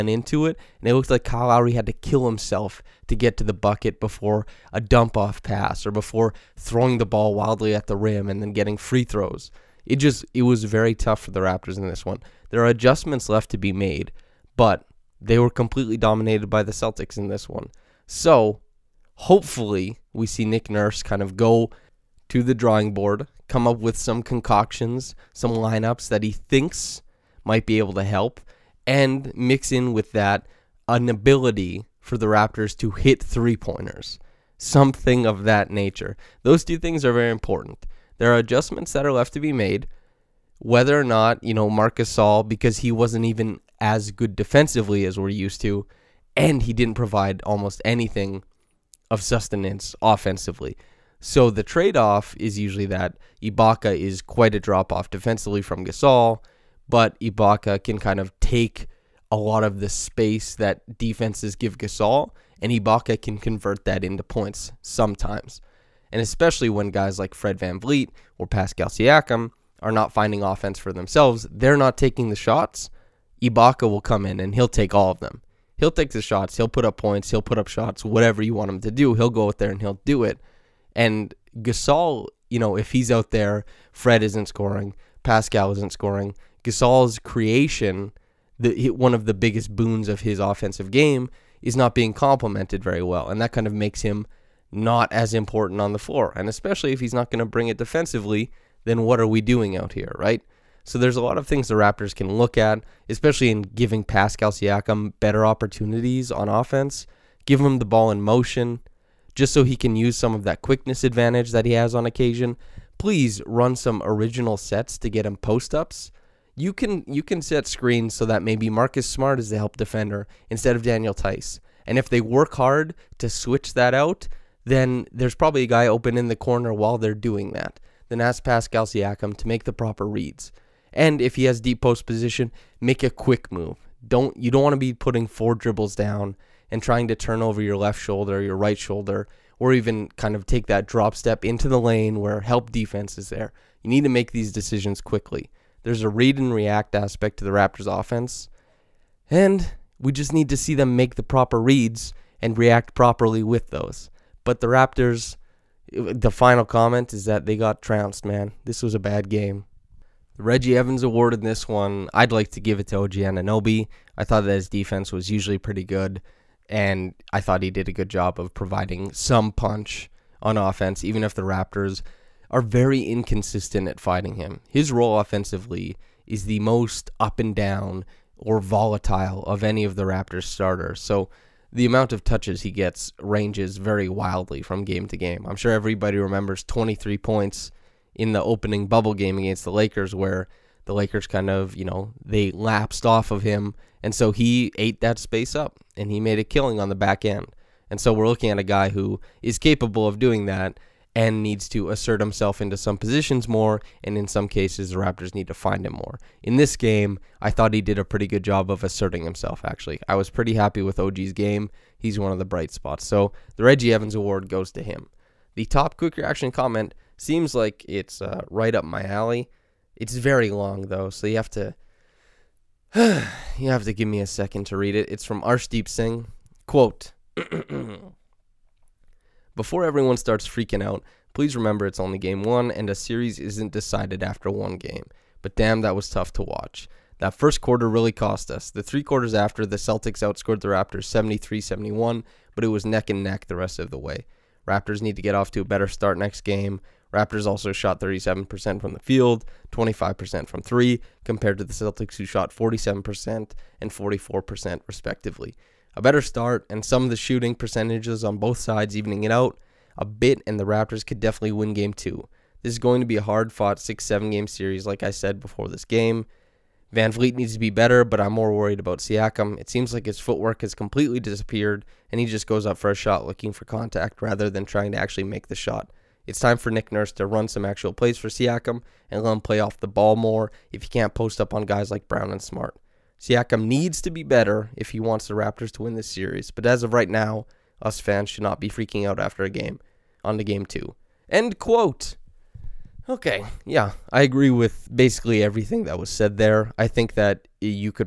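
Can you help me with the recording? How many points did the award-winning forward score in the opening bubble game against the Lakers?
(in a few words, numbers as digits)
23.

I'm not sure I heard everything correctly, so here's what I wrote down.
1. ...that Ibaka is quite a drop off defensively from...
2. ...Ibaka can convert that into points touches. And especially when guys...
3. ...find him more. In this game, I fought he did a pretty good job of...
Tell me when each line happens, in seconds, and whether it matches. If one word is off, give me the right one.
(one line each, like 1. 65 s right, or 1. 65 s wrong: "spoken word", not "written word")
1. 52 s right
2. 62 s wrong: "sometimes", not "touches"
3. 205 s wrong: "thought", not "fought".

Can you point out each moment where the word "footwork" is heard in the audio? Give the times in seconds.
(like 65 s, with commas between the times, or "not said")
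270 s.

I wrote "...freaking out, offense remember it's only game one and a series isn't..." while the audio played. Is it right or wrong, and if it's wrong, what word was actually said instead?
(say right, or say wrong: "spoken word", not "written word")
wrong: "please", not "offense".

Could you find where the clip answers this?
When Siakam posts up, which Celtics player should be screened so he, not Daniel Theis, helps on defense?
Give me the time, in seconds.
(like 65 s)
118 s.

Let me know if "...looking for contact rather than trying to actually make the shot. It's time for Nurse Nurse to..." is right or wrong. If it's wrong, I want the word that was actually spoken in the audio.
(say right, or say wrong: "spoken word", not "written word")
wrong: "Nick", not "Nurse".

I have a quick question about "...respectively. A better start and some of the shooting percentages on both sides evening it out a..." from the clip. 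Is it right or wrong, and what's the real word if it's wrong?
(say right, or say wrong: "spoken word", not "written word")
right.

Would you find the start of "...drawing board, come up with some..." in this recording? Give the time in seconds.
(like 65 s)
22 s.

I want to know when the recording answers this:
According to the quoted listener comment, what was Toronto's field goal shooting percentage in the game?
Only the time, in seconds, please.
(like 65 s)
248 s.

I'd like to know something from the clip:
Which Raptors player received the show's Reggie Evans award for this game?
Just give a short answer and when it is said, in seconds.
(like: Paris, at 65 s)
OG Anunoby, at 162 s.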